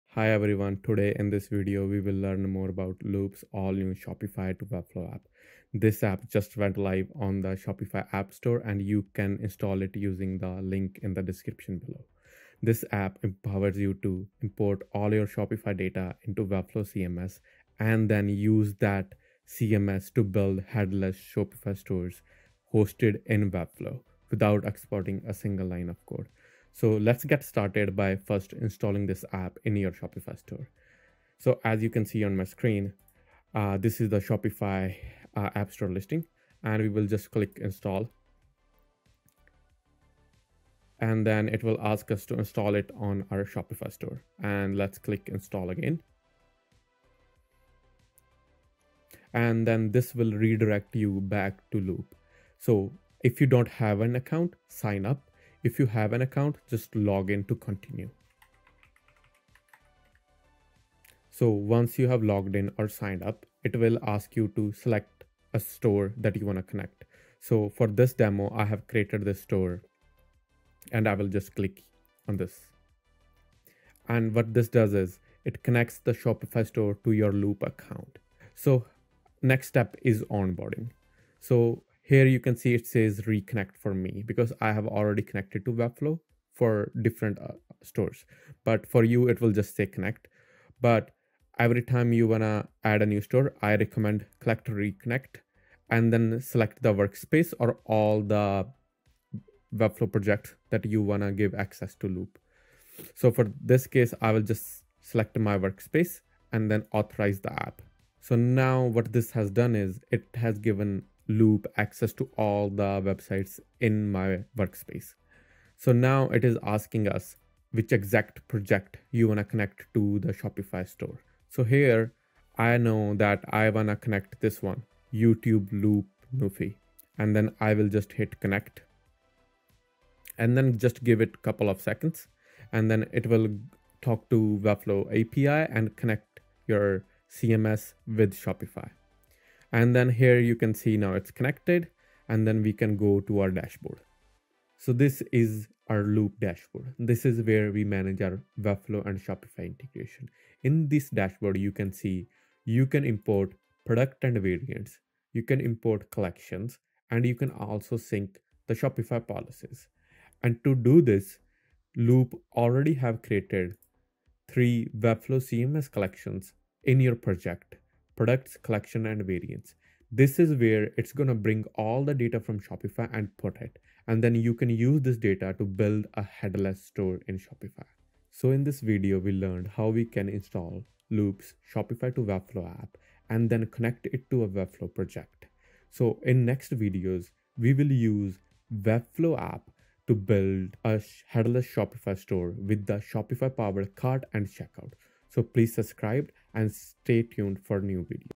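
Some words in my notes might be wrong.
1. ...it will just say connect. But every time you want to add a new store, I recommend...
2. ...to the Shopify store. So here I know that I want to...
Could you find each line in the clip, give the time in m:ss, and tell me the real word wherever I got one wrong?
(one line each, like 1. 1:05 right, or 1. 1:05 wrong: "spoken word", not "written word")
1. 1:29 right
2. 1:59 right.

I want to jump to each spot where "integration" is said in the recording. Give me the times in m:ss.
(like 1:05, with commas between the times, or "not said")
2:29.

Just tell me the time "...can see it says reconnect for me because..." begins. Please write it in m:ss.
1:22.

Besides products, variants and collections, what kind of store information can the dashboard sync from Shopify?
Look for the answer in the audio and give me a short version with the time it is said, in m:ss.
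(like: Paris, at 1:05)
Shopify policies, at 2:38.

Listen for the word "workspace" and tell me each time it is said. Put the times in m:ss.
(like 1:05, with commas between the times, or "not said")
1:36, 1:45, 1:54.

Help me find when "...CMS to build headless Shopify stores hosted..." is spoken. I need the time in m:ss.
0:19.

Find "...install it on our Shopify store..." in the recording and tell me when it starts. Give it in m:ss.
0:42.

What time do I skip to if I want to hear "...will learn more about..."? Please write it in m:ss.
0:02.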